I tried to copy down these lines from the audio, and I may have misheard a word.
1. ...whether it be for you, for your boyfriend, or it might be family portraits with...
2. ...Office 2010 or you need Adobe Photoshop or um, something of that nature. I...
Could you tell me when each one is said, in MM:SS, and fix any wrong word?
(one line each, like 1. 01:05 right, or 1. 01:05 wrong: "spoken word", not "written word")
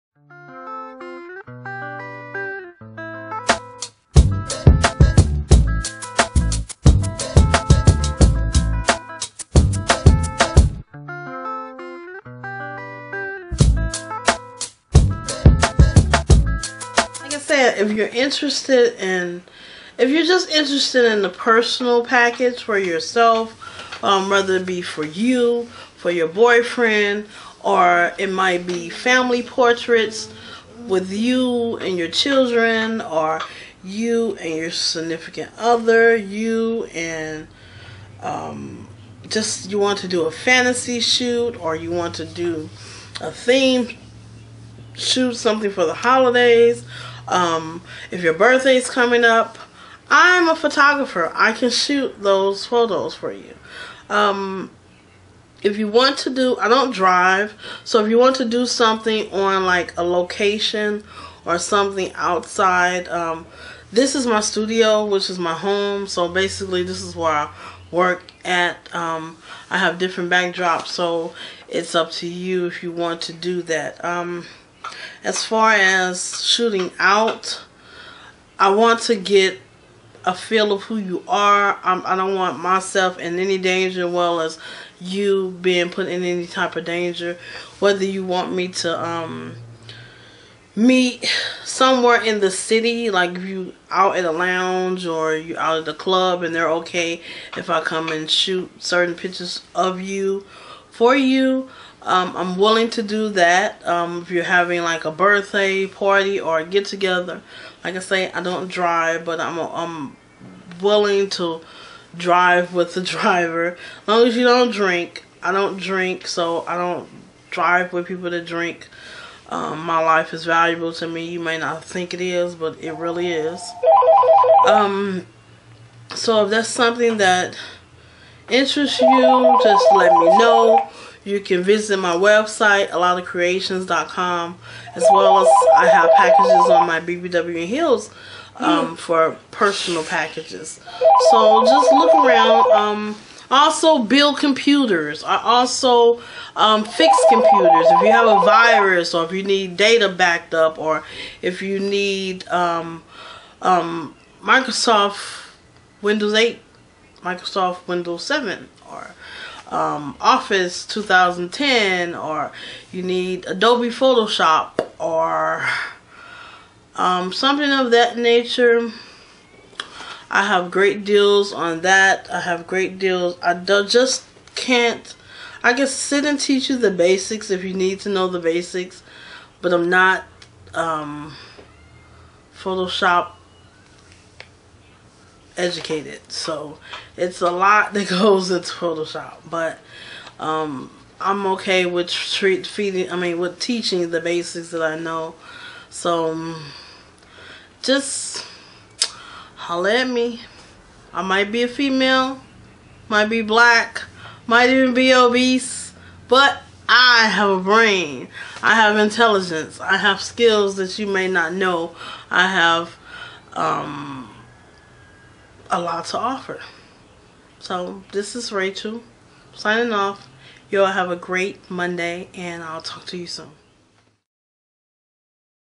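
1. 00:24 right
2. 02:40 right.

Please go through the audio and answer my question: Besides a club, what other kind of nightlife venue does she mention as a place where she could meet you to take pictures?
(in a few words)
lounge.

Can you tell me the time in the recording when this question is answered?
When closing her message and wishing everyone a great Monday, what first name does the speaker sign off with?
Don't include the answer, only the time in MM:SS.
03:38.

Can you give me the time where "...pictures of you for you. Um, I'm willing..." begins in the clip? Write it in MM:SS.
01:39.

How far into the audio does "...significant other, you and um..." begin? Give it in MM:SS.
00:34.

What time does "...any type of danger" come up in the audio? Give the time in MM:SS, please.
01:26.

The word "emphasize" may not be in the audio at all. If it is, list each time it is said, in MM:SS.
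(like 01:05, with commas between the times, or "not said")
not said.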